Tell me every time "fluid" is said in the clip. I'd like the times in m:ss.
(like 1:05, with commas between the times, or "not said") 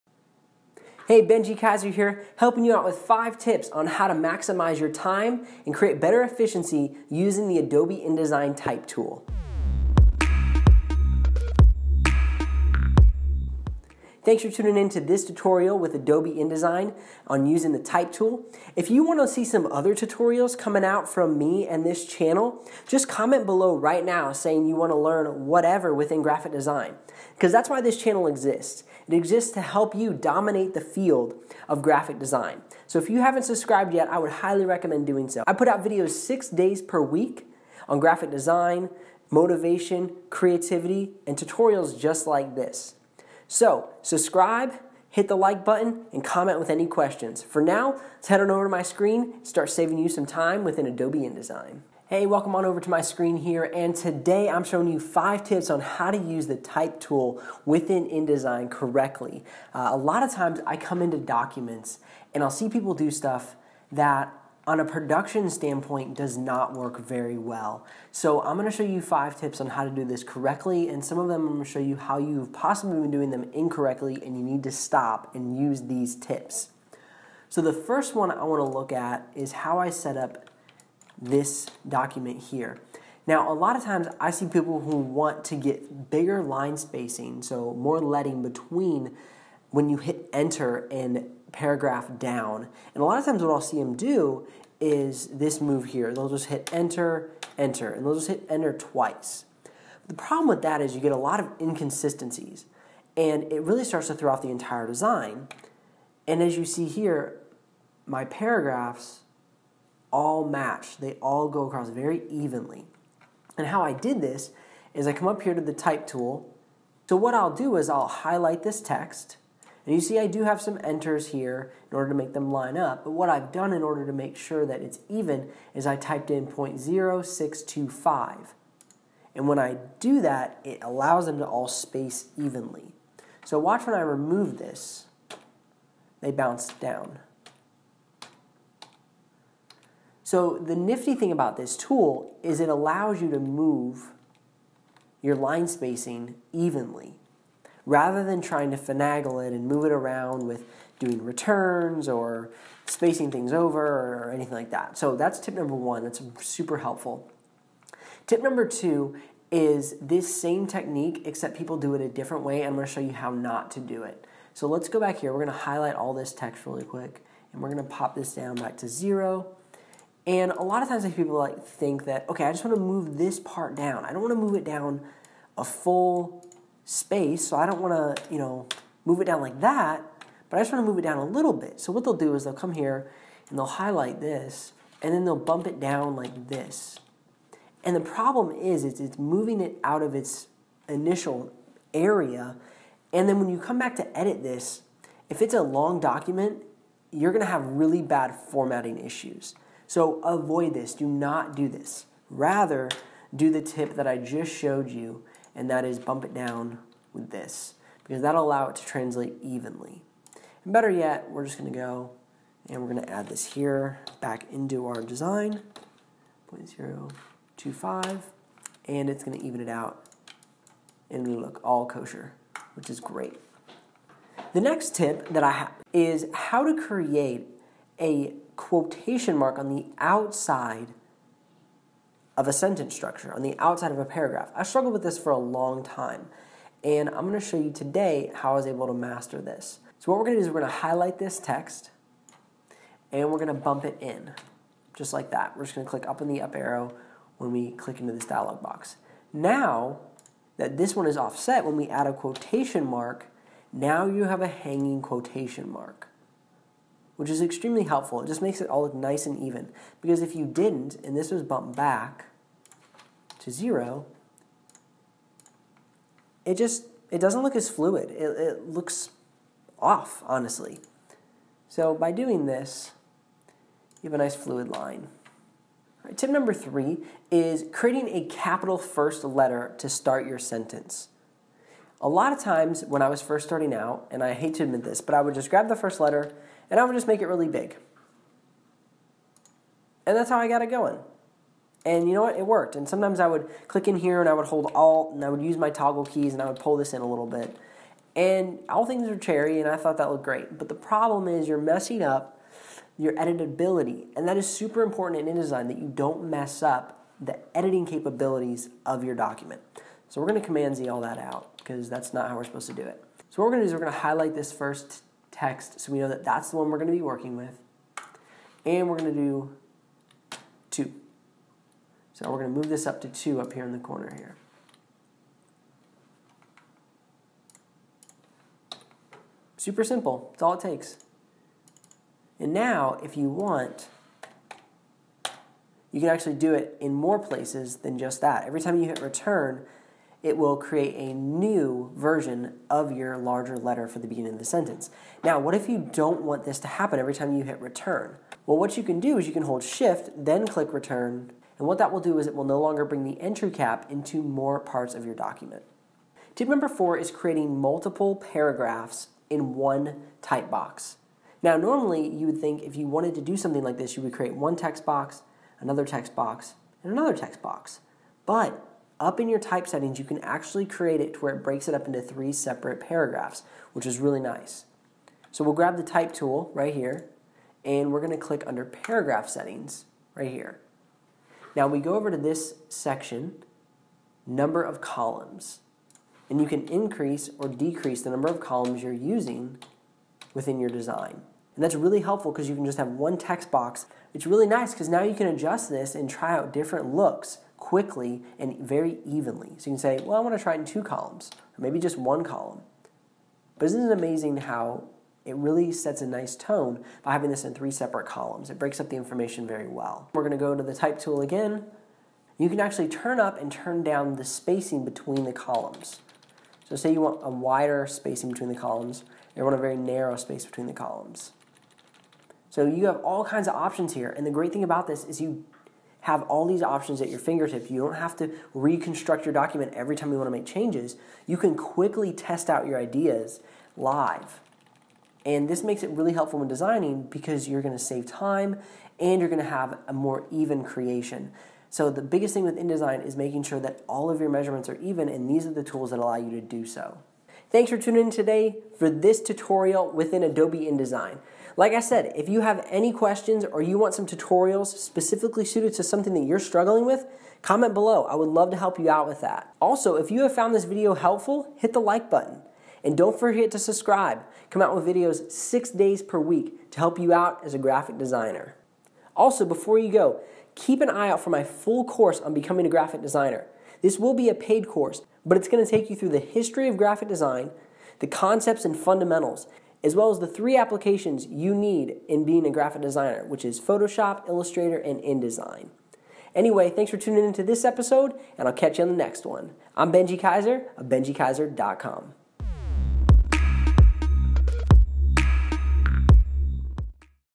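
4:27, 4:34.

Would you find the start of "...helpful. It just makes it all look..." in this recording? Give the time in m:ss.
4:17.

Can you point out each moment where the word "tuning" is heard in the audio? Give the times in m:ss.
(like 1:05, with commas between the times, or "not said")
0:14, 7:27, 8:06.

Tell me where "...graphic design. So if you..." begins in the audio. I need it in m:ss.
0:31.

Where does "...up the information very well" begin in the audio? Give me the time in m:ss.
6:48.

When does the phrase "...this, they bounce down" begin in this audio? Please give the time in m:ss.
2:14.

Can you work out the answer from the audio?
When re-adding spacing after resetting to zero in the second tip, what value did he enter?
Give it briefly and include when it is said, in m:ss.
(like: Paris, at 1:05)
0.025, at 3:36.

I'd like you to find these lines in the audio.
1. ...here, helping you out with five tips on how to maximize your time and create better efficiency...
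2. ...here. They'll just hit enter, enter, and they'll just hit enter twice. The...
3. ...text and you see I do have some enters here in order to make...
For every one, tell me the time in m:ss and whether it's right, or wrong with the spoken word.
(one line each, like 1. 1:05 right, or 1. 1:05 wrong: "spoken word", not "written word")
1. 0:01 right
2. 1:35 right
3. 1:58 right.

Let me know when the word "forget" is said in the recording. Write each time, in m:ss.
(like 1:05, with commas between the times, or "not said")
7:43.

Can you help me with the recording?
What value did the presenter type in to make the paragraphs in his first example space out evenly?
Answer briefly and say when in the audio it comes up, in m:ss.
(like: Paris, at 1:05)
0.0625, at 2:06.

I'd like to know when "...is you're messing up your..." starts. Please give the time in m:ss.
5:01.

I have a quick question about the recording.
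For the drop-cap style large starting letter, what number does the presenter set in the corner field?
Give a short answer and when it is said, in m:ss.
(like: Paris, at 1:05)
2, at 5:23.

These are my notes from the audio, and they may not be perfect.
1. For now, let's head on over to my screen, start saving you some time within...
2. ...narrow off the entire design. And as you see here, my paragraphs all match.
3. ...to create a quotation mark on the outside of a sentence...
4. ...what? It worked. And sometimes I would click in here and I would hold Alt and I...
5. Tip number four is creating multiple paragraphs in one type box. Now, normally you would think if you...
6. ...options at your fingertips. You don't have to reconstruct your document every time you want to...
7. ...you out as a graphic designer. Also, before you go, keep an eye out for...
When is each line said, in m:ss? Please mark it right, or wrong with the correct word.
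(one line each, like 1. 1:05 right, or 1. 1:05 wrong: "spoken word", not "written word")
1. 0:47 right
2. 1:44 wrong: "throw", not "narrow"
3. 3:46 right
4. 4:52 right
5. 5:56 right
6. 7:06 right
7. 7:46 right.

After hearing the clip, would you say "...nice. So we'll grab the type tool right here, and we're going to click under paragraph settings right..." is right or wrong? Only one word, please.
right.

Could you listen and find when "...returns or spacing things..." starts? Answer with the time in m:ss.
2:31.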